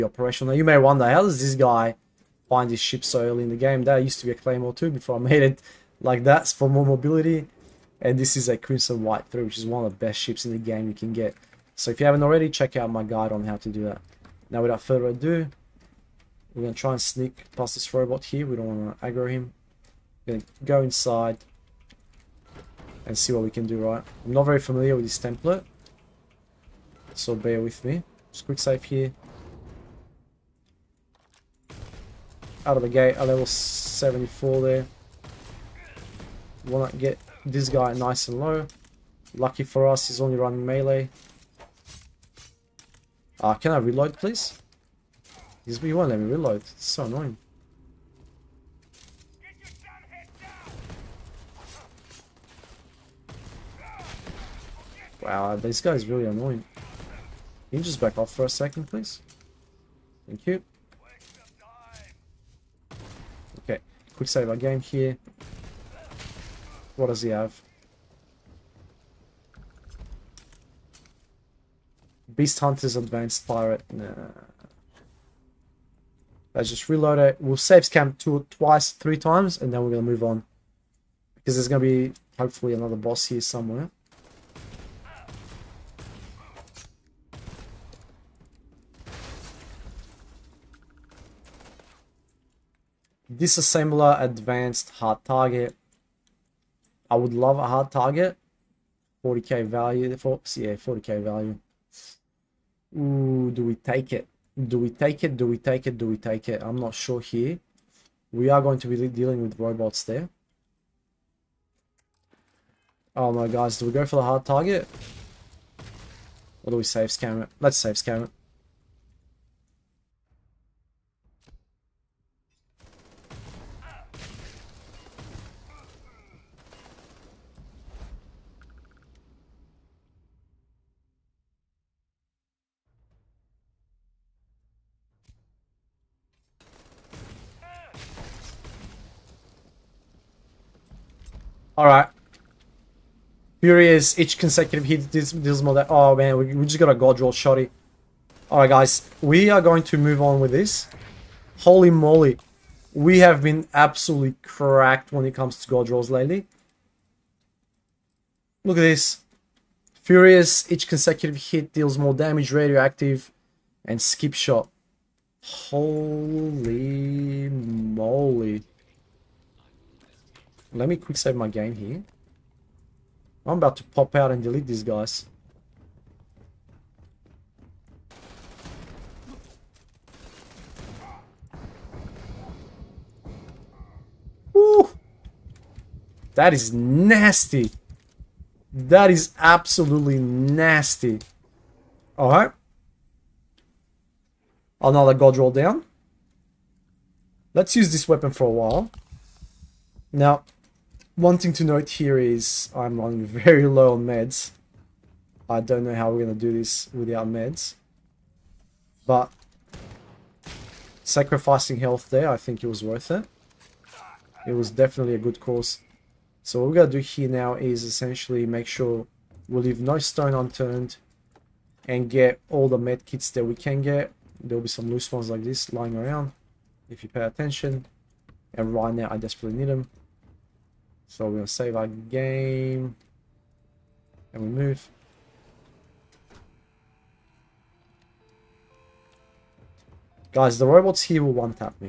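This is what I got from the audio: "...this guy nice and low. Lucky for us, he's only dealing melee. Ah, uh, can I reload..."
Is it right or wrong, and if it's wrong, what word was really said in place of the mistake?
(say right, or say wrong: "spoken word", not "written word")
wrong: "running", not "dealing".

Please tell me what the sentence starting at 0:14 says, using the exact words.
Now, without further ado, we're going to try and sneak past this robot here.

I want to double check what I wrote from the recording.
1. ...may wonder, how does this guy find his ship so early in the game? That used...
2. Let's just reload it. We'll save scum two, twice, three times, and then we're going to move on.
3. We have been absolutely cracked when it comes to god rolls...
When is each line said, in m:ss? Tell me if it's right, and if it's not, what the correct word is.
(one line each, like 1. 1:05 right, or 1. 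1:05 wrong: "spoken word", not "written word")
1. 0:00 right
2. 1:16 right
3. 2:32 right.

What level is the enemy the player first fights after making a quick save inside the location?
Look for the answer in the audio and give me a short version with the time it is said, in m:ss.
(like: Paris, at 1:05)
74, at 0:33.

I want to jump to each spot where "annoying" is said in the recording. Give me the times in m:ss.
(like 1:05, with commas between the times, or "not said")
0:47, 0:56.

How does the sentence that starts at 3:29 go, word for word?
But sacrificing health there, I think it was worth it.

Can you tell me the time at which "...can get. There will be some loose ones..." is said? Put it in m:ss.
3:43.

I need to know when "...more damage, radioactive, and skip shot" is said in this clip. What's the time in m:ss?
2:41.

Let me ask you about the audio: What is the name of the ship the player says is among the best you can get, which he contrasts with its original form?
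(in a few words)
Crimson White 3.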